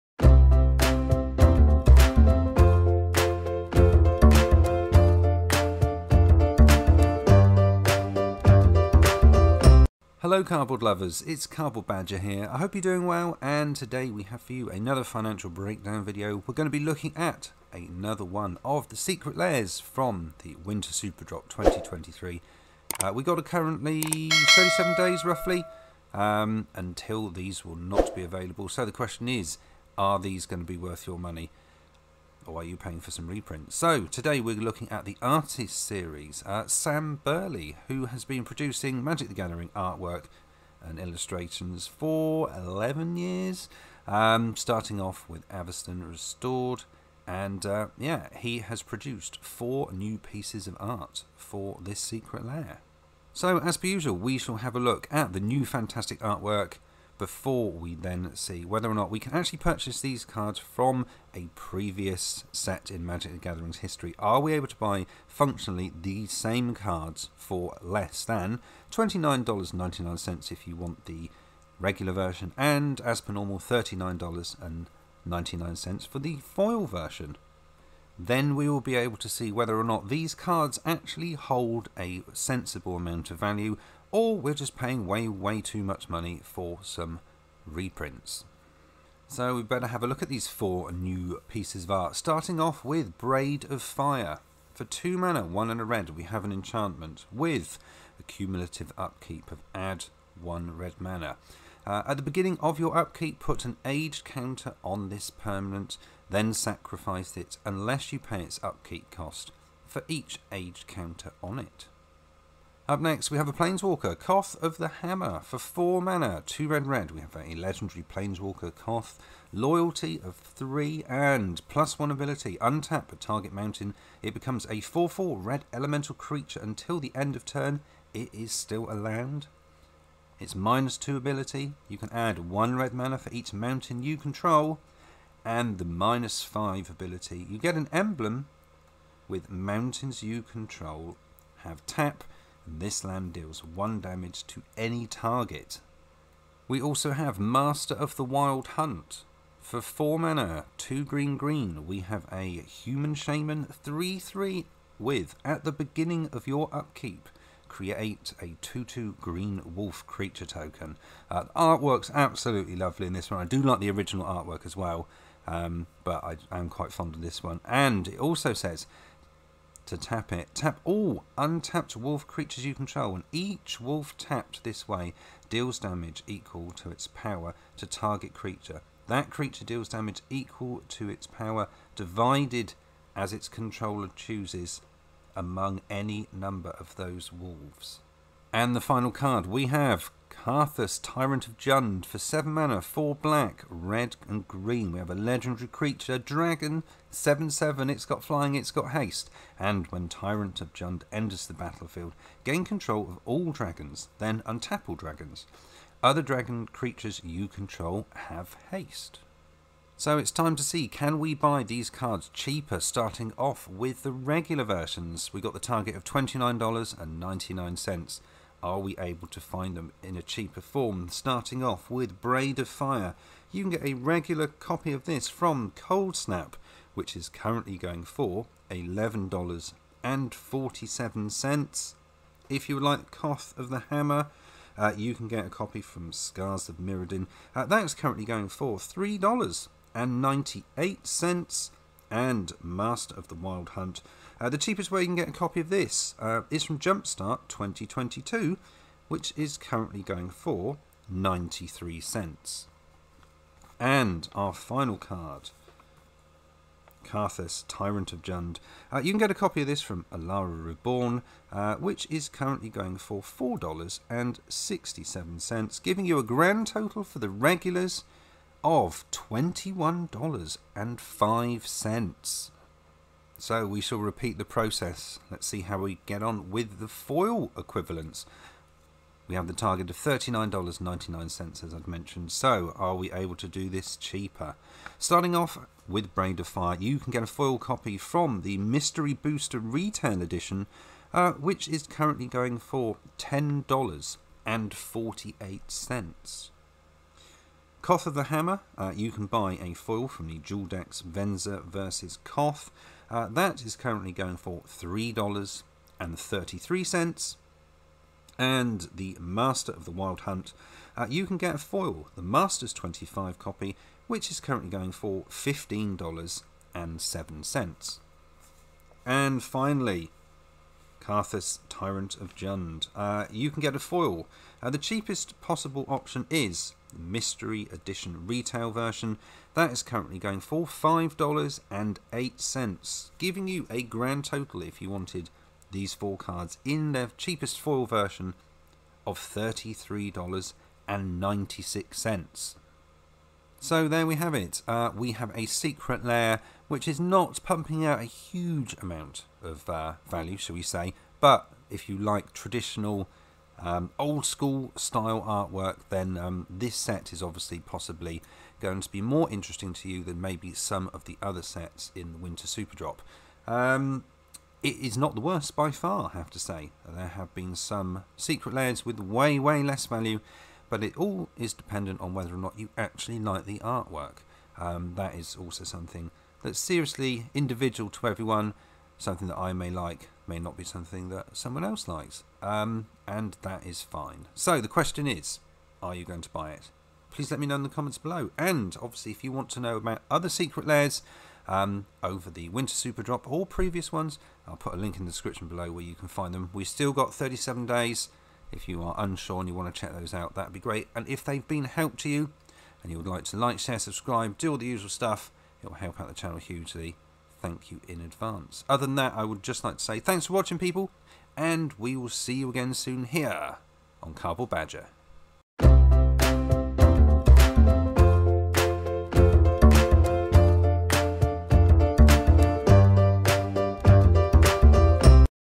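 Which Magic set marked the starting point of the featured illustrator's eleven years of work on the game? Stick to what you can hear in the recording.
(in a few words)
Avacyn Restored.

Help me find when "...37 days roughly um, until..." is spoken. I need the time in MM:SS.
00:24.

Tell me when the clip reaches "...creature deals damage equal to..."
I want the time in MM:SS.
02:59.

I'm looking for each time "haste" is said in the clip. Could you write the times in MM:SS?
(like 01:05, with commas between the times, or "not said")
03:18, 03:28.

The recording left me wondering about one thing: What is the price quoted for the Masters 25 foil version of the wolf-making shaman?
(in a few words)
$15.07.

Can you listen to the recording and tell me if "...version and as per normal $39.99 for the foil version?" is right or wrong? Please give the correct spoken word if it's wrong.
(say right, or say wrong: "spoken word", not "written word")
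right.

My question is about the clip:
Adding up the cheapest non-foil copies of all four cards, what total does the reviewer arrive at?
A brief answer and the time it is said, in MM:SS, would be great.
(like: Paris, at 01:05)
$21.05, at 04:29.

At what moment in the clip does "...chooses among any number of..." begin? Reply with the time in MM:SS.
03:04.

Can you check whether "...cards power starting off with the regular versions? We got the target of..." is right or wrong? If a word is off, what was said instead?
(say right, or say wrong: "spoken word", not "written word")
wrong: "cheaper", not "power".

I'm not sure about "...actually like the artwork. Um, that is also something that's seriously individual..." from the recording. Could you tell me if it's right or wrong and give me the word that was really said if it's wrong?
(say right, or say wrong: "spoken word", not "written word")
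right.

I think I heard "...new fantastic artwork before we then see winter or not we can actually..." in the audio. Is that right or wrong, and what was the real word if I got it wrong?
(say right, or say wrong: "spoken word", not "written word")
wrong: "whether", not "winter".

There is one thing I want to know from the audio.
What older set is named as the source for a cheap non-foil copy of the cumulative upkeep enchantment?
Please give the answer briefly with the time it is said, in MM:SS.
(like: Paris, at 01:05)
Coldsnap, at 03:45.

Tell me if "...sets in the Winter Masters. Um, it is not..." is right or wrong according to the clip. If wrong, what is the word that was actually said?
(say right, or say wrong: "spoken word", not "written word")
wrong: "Superdrop", not "Masters".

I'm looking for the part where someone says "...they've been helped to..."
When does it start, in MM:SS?
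06:41.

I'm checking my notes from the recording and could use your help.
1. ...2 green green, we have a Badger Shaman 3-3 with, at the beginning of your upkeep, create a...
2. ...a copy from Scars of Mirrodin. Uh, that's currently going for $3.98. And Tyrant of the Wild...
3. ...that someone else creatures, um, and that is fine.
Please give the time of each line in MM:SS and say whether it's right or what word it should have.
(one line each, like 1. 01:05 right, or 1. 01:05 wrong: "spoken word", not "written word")
1. 02:30 wrong: "Human", not "Badger"
2. 03:55 wrong: "Master", not "Tyrant"
3. 06:21 wrong: "likes", not "creatures".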